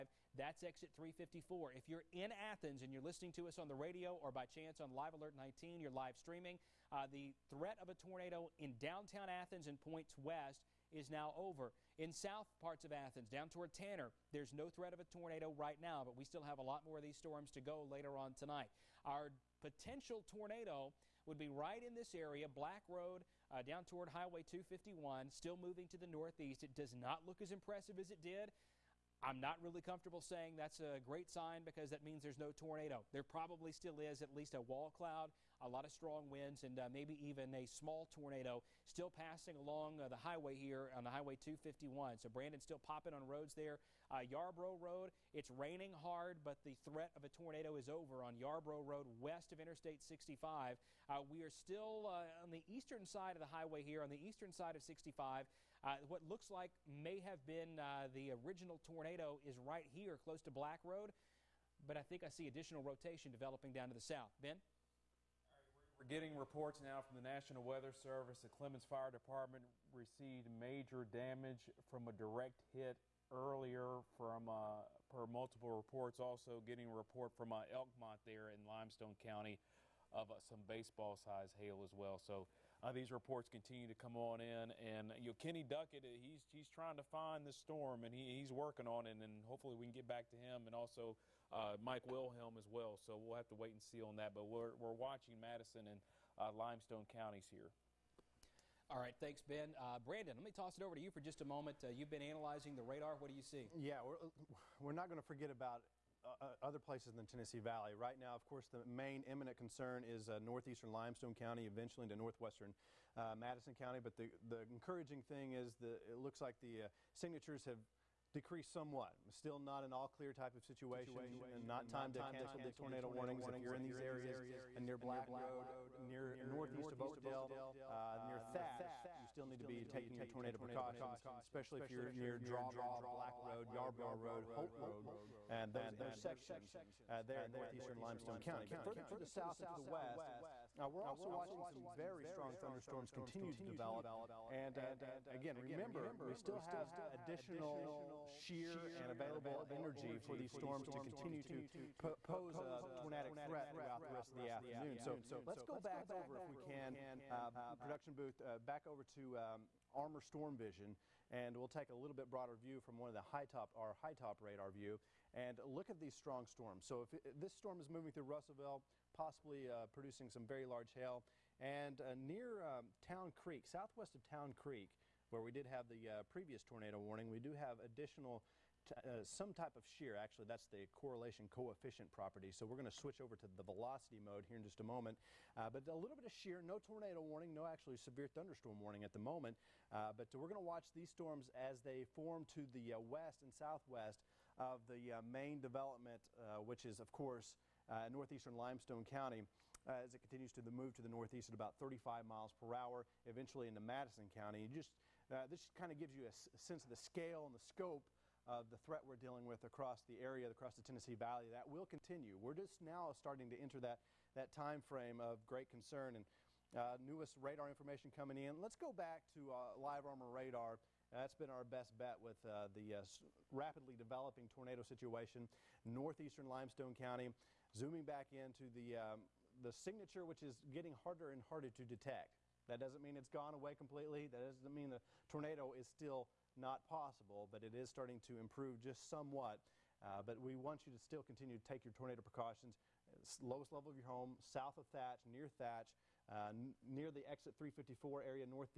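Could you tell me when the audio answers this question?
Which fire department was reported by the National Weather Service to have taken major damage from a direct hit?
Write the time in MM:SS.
01:08.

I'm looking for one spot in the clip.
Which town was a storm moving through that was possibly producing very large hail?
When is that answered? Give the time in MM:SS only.
02:48.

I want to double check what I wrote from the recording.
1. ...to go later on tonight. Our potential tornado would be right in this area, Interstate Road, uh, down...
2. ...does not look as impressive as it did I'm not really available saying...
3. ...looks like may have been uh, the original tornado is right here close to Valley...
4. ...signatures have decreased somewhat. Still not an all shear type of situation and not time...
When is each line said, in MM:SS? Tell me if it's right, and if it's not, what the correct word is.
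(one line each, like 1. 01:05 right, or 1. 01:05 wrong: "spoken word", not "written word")
1. 00:17 wrong: "Black", not "Interstate"
2. 00:26 wrong: "comfortable", not "available"
3. 00:56 wrong: "Black", not "Valley"
4. 01:57 wrong: "clear", not "shear".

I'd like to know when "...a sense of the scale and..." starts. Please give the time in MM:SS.
03:26.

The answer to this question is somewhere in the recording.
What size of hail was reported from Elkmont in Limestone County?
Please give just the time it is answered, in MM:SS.
01:20.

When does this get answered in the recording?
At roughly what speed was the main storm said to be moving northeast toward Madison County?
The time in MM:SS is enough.
03:21.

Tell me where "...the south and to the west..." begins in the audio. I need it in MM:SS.
02:19.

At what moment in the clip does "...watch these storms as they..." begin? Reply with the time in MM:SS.
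03:10.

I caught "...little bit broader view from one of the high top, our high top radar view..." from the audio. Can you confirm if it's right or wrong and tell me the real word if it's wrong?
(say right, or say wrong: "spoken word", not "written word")
right.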